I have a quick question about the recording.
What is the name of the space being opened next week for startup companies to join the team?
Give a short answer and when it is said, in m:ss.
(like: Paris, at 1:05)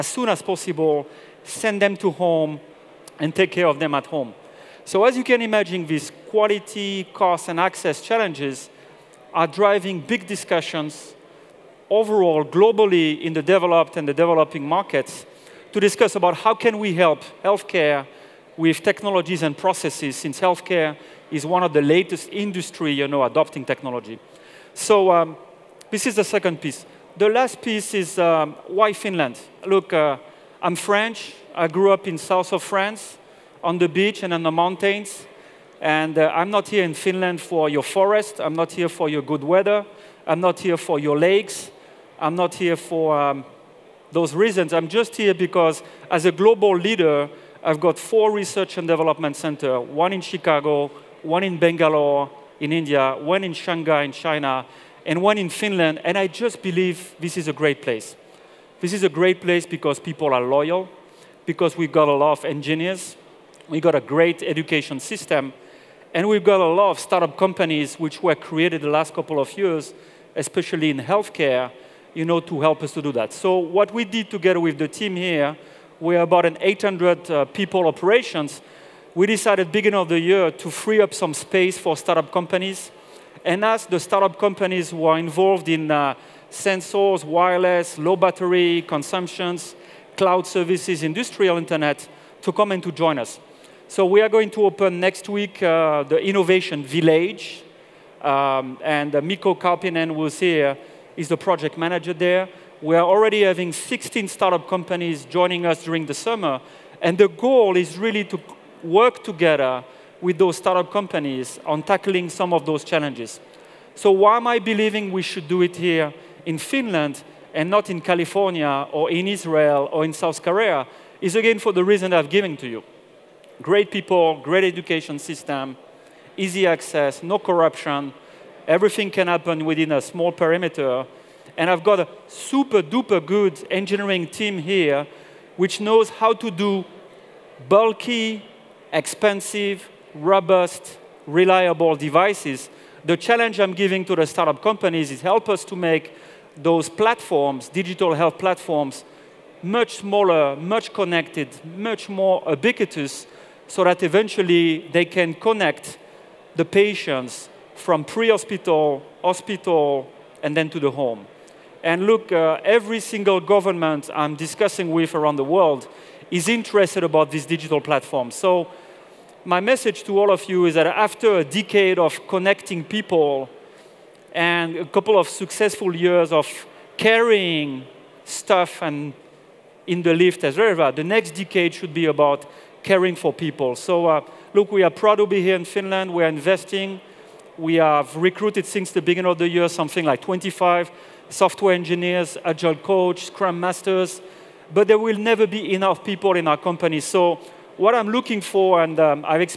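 Innovation Village, at 1:36.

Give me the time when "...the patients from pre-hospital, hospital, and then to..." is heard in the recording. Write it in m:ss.
2:36.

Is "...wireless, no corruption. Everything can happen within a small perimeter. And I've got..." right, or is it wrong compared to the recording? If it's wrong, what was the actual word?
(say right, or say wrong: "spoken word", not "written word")
wrong: "access", not "wireless".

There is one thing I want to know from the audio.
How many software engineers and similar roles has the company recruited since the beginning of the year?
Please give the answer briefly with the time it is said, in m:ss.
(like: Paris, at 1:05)
25, at 3:10.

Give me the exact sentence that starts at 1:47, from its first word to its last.
And the goal is really to work together with those startup companies on tackling some of those challenges.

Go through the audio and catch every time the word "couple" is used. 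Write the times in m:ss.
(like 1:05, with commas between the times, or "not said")
1:09, 2:54.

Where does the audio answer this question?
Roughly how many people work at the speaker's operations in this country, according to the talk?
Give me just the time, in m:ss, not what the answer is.
1:16.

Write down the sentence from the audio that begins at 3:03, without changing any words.
So uh, look, we are proud to be here in Finland.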